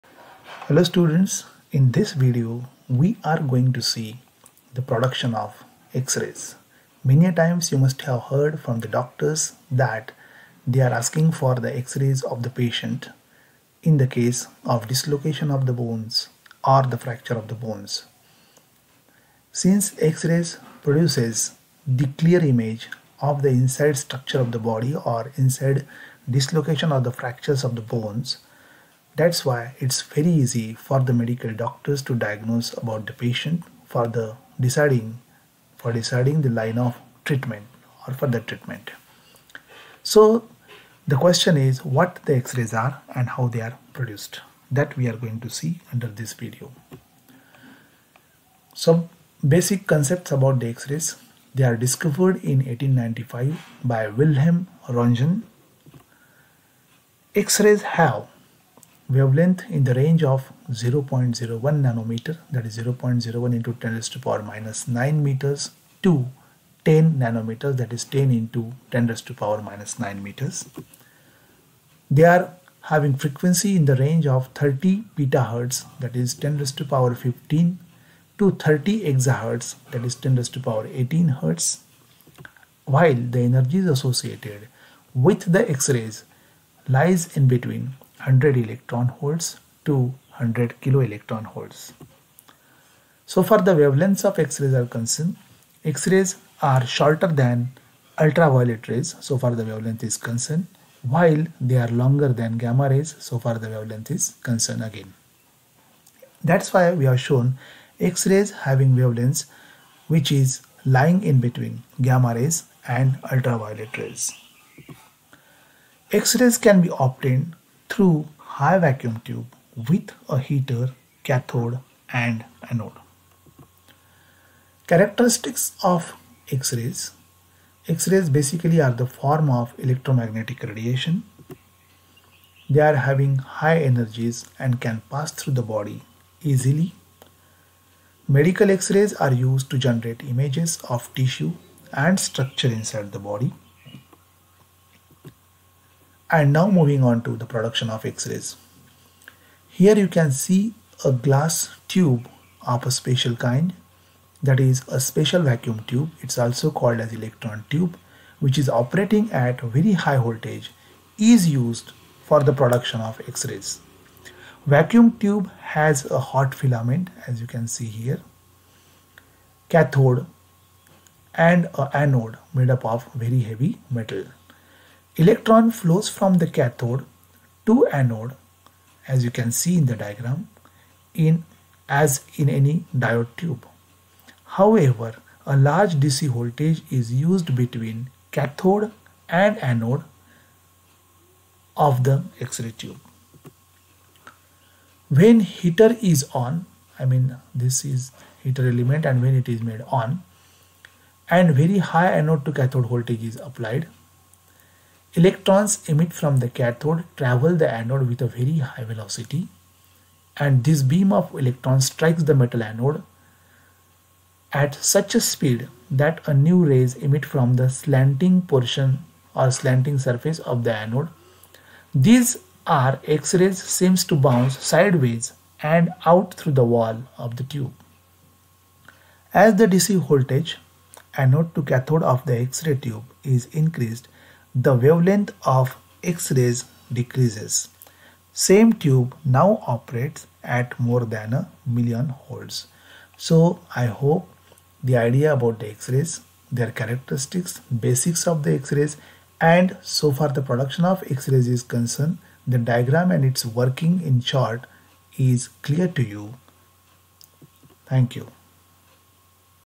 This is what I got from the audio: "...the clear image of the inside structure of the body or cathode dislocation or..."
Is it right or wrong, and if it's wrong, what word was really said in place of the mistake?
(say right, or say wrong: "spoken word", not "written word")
wrong: "inside", not "cathode".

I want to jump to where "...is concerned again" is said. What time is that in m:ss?
1:44.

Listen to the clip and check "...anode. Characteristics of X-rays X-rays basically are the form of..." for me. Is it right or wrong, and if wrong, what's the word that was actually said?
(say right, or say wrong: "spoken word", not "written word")
right.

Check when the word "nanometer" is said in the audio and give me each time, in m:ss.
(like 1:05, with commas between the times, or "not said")
1:01, 1:07.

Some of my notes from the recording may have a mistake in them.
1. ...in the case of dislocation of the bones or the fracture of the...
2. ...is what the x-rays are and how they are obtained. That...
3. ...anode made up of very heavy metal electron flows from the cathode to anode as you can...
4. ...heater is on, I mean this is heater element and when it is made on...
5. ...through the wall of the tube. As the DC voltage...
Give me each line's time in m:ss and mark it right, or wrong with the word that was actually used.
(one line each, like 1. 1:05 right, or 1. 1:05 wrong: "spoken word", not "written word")
1. 0:13 right
2. 0:41 wrong: "produced", not "obtained"
3. 2:51 right
4. 3:15 right
5. 3:46 right.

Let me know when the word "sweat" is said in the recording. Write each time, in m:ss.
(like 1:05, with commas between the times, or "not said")
not said.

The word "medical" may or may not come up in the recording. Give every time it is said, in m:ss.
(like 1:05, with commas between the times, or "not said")
0:31, 2:18.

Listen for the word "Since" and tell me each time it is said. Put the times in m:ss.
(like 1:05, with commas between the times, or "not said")
0:19.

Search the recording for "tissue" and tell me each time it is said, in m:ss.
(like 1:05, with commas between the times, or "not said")
2:21.